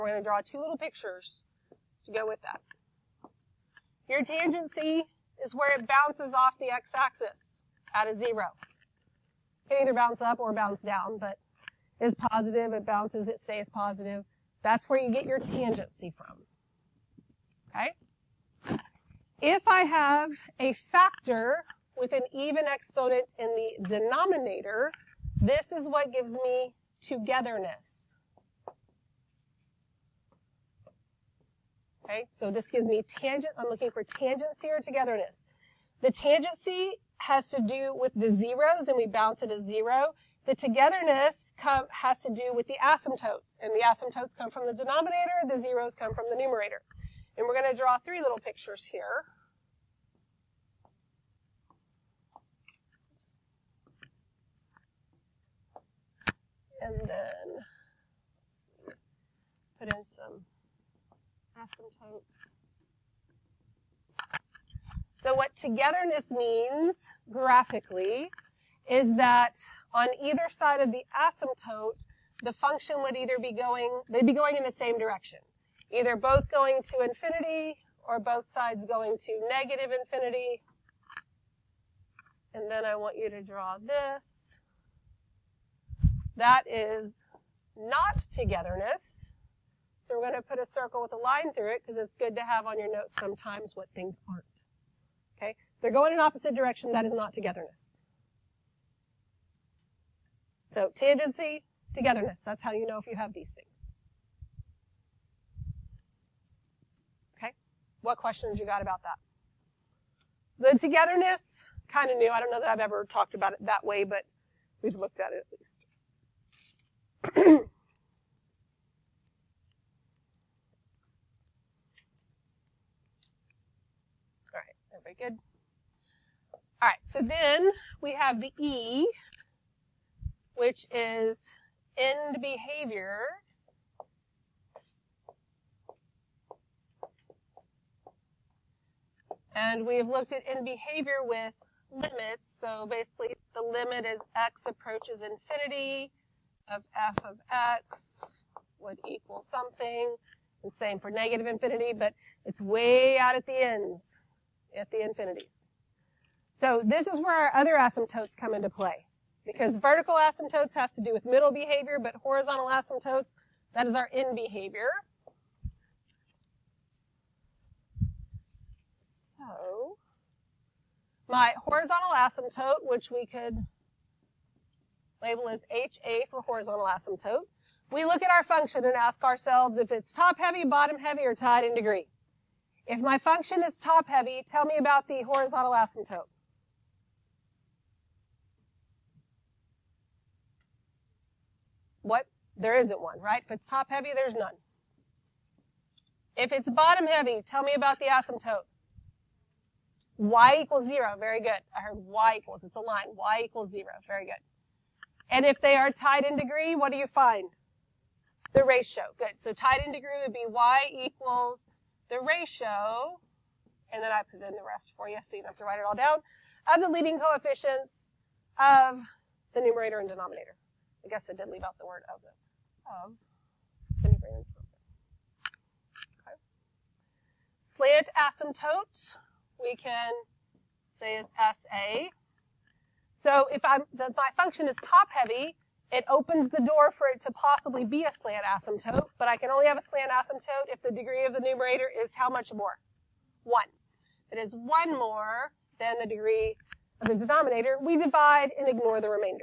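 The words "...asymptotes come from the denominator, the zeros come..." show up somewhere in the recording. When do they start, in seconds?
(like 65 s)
43 s.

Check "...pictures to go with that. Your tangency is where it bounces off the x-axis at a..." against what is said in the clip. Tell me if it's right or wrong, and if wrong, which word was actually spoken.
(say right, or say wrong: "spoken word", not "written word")
right.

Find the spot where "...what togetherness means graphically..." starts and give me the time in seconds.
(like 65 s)
65 s.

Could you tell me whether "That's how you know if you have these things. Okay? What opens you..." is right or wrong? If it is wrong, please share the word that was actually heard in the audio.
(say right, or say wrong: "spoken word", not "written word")
wrong: "questions", not "opens".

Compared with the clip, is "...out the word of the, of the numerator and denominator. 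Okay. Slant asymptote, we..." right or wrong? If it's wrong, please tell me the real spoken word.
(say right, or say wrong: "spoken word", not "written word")
right.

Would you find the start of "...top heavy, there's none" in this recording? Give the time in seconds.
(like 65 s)
193 s.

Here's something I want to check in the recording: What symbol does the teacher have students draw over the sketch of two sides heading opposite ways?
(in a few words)
a circle with a line through it.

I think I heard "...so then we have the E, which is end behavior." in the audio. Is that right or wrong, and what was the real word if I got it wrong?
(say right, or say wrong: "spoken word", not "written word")
right.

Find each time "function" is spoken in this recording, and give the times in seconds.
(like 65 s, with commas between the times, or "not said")
72 s, 178 s, 183 s, 234 s.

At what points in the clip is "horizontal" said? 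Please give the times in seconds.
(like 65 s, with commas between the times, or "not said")
162 s, 171 s, 176 s, 185 s.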